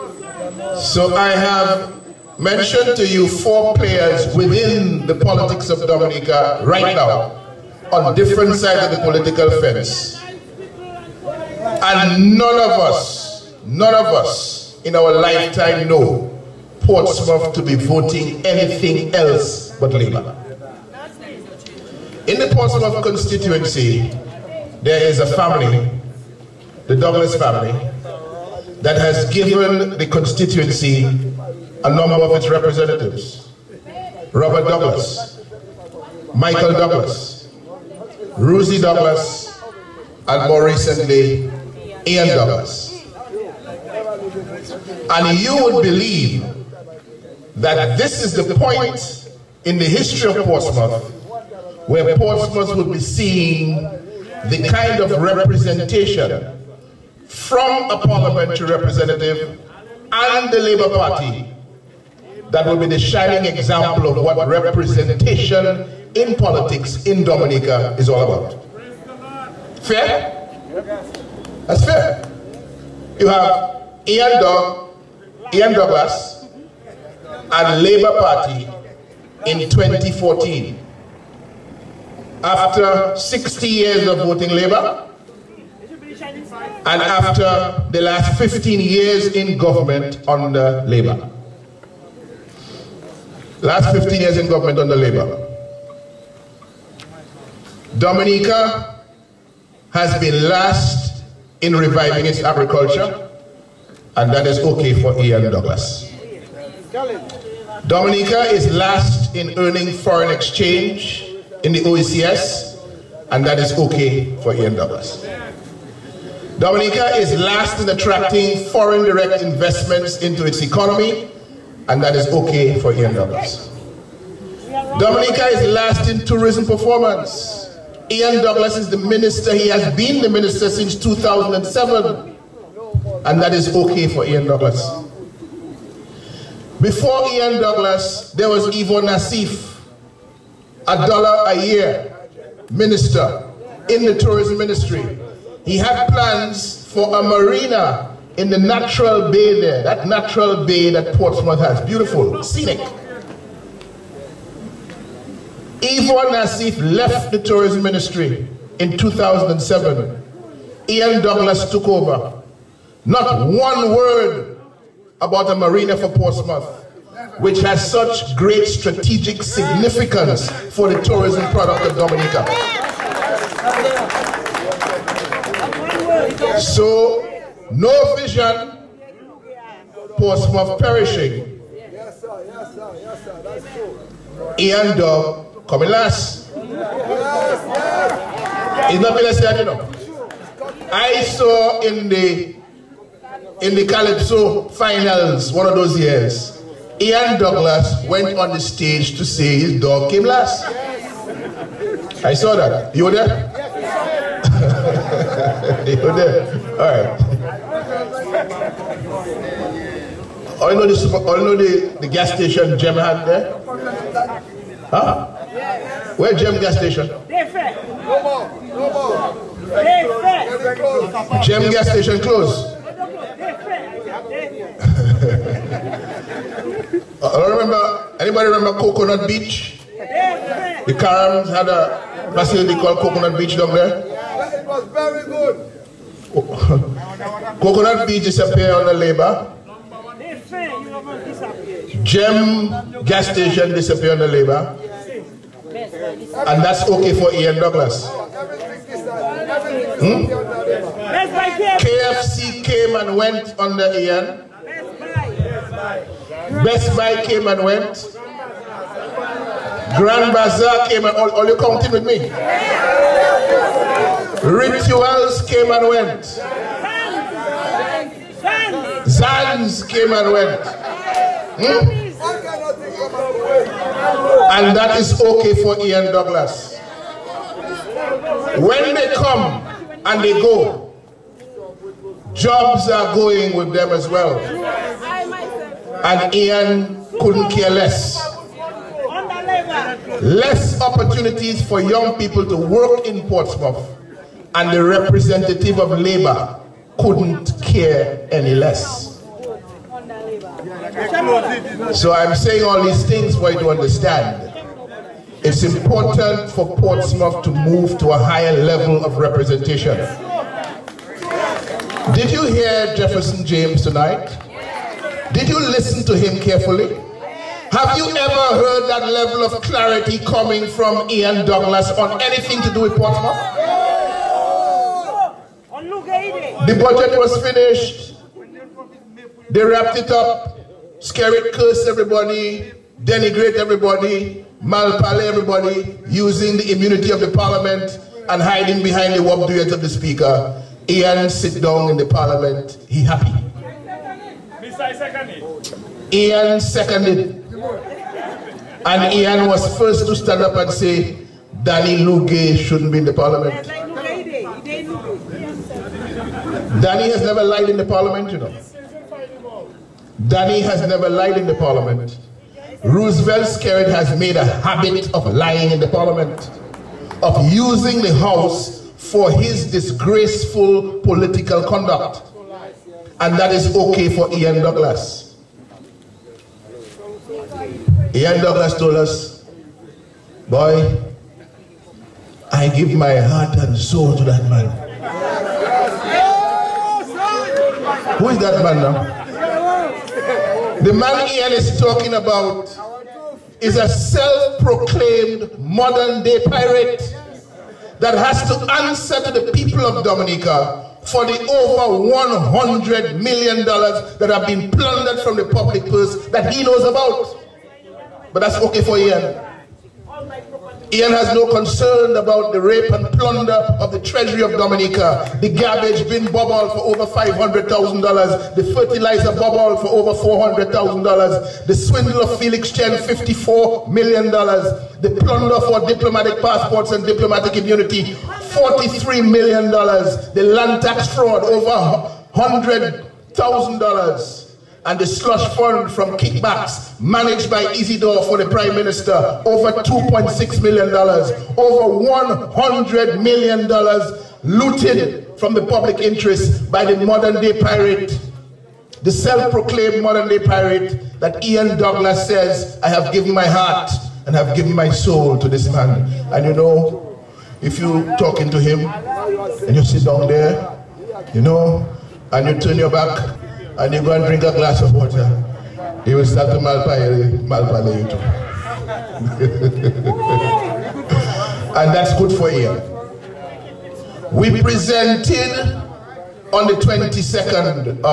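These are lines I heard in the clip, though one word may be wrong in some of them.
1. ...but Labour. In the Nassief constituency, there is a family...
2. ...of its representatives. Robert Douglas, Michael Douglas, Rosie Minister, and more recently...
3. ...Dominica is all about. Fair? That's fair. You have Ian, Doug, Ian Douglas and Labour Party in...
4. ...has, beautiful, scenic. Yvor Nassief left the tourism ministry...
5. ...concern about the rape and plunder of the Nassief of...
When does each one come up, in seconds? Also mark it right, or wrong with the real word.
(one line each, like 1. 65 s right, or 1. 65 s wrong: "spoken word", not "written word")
1. 19 s wrong: "Portsmouth", not "Nassief"
2. 32 s wrong: "Douglas", not "Minister"
3. 67 s right
4. 151 s right
5. 411 s wrong: "Treasury", not "Nassief".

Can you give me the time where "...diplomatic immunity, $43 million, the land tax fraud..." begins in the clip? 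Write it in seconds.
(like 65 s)
427 s.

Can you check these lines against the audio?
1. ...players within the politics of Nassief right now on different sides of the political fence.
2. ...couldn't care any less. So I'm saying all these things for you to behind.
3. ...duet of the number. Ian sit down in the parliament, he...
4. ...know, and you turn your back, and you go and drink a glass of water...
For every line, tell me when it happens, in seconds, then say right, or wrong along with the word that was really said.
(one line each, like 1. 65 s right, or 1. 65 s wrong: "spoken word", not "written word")
1. 3 s wrong: "Dominica", not "Nassief"
2. 296 s wrong: "understand", not "behind"
3. 339 s wrong: "speaker", not "number"
4. 461 s right.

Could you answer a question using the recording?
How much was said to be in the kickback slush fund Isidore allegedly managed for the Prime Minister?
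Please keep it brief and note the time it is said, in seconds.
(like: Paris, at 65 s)
over $2.6 million, at 439 s.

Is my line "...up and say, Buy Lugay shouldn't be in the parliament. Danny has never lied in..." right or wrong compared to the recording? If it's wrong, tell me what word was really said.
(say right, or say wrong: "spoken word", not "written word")
wrong: "Danny", not "Buy".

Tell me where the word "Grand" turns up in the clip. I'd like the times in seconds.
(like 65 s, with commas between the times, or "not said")
259 s.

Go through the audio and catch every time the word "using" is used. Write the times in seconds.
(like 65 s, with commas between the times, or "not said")
336 s, 367 s.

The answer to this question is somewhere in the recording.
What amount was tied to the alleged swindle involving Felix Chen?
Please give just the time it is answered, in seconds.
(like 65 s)
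423 s.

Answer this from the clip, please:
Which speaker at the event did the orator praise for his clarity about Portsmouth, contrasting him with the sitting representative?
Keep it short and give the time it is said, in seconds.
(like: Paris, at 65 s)
Jefferson James, at 312 s.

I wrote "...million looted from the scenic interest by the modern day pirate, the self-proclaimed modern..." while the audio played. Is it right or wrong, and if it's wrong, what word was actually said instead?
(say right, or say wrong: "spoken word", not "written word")
wrong: "public", not "scenic".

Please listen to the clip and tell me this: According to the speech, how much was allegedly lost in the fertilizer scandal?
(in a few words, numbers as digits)
over $400,000.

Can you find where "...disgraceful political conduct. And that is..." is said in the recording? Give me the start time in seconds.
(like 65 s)
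369 s.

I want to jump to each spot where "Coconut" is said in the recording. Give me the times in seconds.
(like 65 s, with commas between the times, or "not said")
228 s, 232 s, 237 s.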